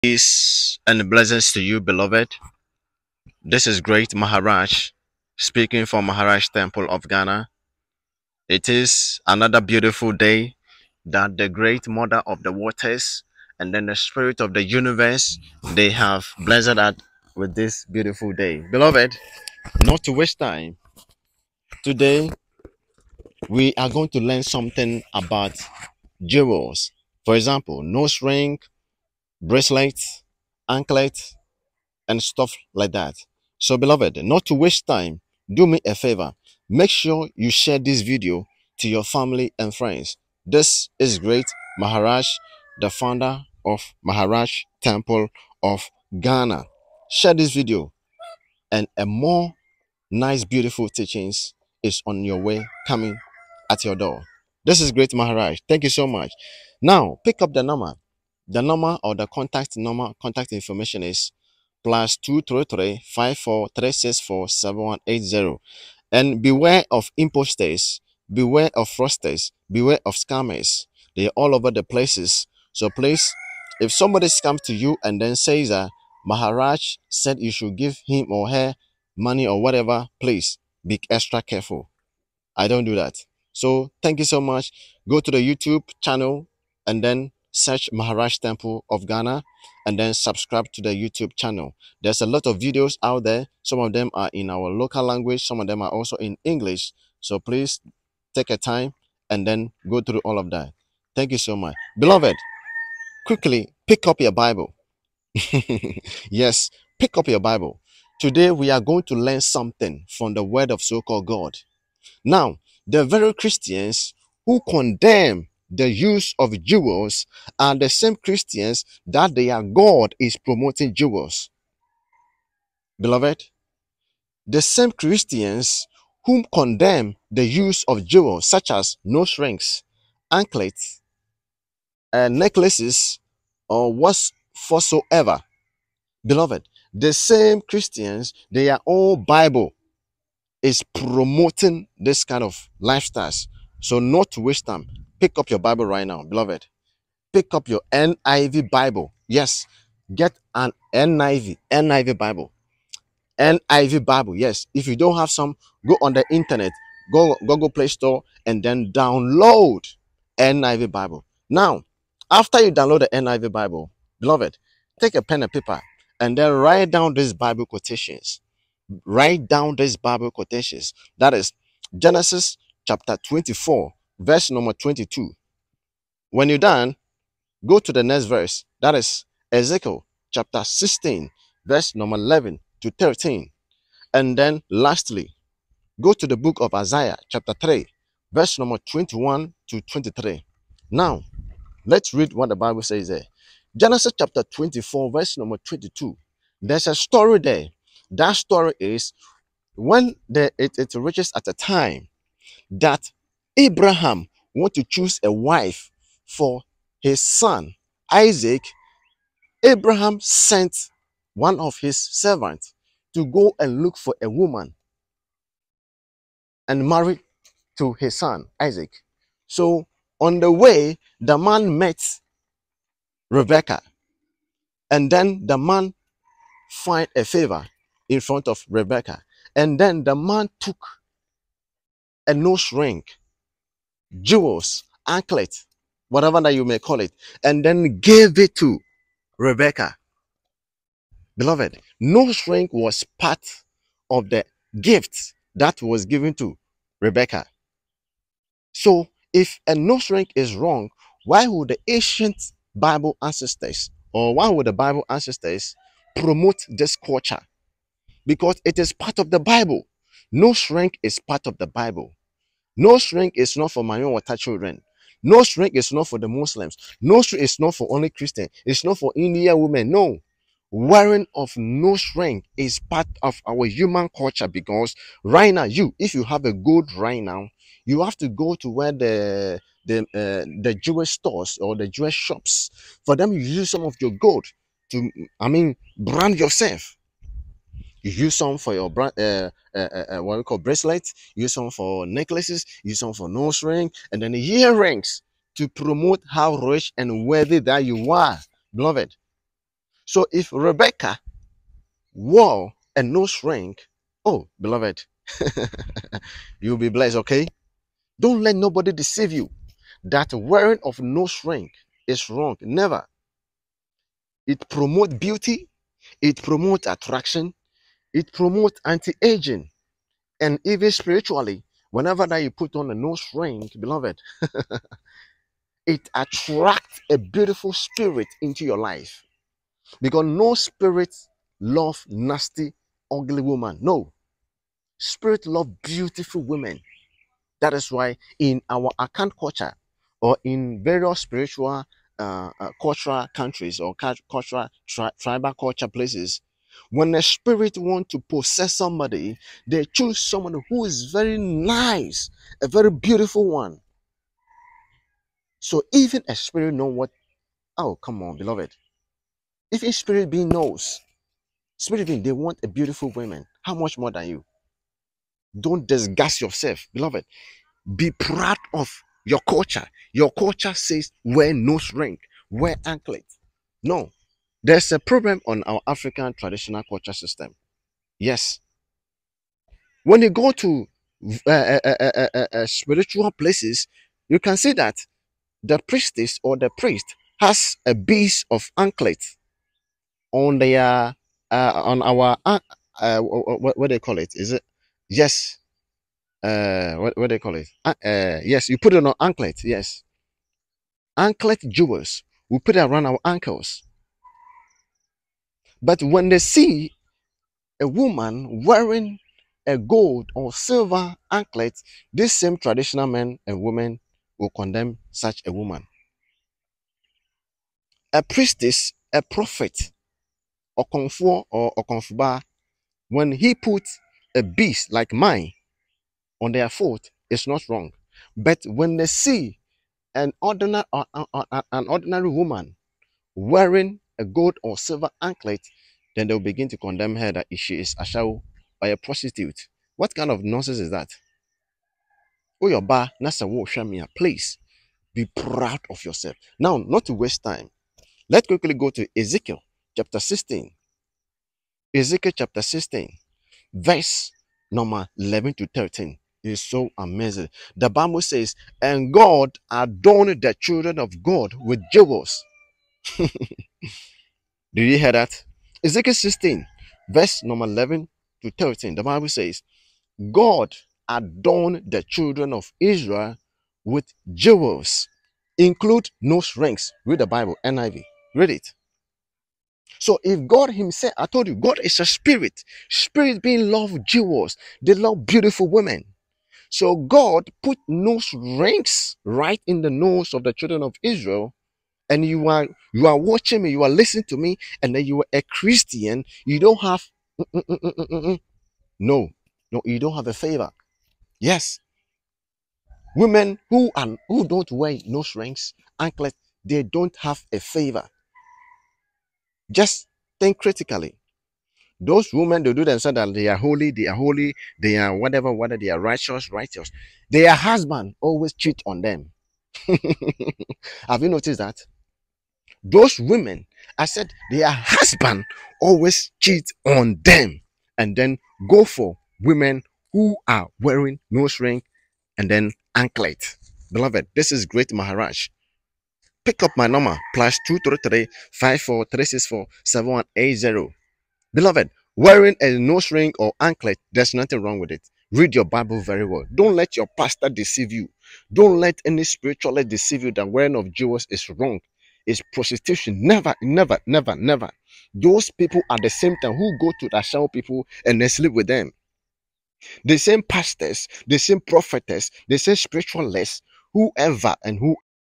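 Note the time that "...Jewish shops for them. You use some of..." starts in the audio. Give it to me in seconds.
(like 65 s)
281 s.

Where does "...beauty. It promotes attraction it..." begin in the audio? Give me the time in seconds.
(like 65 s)
315 s.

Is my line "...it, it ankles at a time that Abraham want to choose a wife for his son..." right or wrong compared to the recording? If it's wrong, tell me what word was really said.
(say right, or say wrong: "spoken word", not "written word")
wrong: "reaches", not "ankles".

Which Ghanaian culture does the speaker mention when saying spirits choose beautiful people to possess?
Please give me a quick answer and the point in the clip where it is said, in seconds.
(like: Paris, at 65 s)
Akan, at 338 s.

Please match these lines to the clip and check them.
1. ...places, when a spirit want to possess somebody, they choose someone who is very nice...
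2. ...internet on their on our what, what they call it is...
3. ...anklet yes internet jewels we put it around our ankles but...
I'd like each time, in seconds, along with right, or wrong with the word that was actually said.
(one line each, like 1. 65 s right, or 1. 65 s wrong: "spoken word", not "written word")
1. 345 s right
2. 388 s wrong: "anklet", not "internet"
3. 399 s wrong: "anklet", not "internet".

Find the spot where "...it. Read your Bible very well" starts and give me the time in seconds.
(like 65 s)
544 s.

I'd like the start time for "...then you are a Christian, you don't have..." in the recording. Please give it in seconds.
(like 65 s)
494 s.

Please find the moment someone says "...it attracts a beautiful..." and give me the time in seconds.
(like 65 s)
325 s.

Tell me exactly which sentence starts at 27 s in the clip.
For example, nose ring, bracelets, anklets, and stuff like that.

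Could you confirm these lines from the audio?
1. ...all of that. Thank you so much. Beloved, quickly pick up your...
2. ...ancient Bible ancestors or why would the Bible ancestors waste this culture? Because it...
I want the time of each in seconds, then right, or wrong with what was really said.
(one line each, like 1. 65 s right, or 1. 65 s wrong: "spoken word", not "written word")
1. 100 s right
2. 251 s wrong: "promote", not "waste".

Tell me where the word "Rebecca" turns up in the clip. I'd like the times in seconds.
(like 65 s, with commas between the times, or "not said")
223 s, 228 s, 239 s, 246 s, 300 s.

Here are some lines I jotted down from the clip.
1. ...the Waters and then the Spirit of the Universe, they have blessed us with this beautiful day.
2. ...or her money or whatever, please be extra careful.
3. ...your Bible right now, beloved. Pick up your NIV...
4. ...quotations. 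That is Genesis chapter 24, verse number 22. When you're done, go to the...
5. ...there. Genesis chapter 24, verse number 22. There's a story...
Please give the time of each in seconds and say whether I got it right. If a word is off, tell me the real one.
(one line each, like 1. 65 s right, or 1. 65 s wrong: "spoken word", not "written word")
1. 12 s right
2. 78 s right
3. 145 s right
4. 170 s right
5. 193 s right.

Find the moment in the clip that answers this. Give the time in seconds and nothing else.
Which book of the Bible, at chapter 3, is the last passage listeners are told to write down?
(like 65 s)
186 s.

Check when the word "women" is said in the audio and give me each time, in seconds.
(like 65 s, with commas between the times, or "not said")
269 s, 336 s, 413 s, 485 s, 503 s, 512 s, 523 s, 529 s.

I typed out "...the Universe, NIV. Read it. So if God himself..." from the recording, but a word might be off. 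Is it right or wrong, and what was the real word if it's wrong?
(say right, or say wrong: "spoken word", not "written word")
wrong: "Bible", not "Universe".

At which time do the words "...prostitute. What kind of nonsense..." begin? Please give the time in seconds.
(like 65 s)
438 s.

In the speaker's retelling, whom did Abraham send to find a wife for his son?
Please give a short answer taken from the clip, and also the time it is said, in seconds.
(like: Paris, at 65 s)
One of his servants, at 211 s.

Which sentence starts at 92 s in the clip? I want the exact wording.
There's a lot of videos out there.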